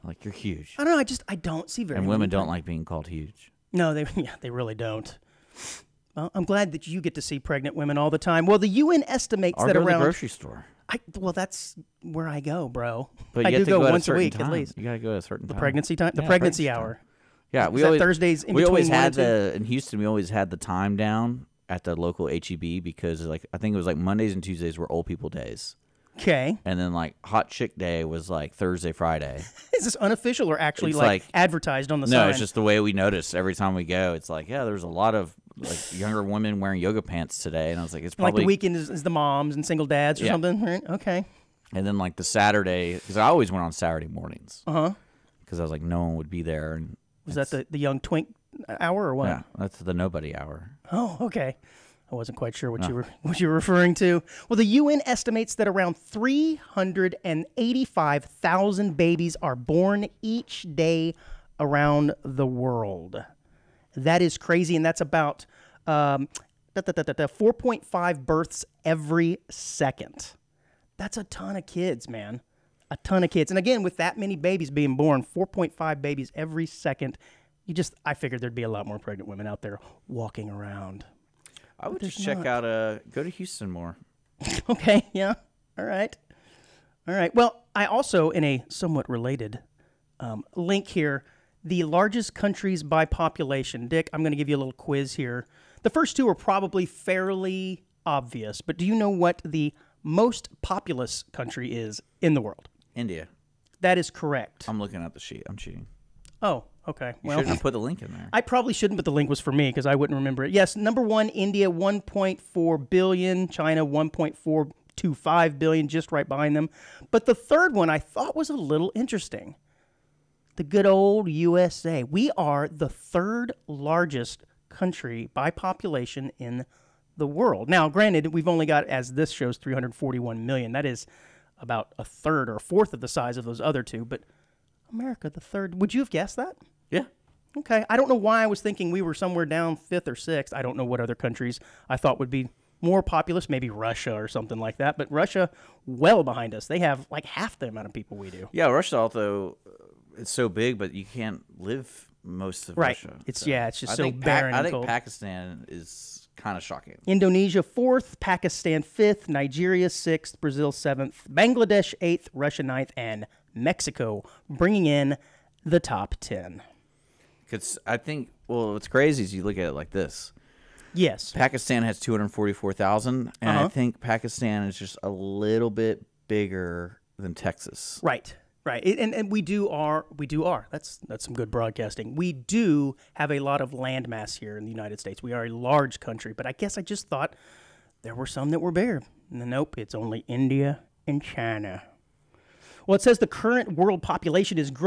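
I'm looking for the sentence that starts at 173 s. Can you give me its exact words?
I think Pakistan is just a little bit bigger than Texas.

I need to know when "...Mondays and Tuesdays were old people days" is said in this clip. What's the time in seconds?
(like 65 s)
23 s.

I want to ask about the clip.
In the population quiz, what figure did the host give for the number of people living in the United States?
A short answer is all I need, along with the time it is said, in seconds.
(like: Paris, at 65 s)
341 million, at 129 s.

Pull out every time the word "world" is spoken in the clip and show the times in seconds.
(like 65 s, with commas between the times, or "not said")
62 s, 102 s, 127 s, 193 s.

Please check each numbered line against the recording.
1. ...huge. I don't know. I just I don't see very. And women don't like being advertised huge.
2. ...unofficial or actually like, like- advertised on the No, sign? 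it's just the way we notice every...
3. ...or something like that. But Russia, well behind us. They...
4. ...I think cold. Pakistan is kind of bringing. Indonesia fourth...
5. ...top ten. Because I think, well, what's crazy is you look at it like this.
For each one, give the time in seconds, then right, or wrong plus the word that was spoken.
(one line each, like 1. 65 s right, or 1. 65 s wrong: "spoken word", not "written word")
1. 0 s wrong: "called", not "advertised"
2. 29 s right
3. 144 s right
4. 154 s wrong: "shocking", not "bringing"
5. 165 s right.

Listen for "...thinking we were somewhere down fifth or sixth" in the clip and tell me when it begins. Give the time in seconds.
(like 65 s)
138 s.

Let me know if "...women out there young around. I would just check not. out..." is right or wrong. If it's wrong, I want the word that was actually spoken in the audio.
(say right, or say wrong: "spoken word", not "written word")
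wrong: "walking", not "young".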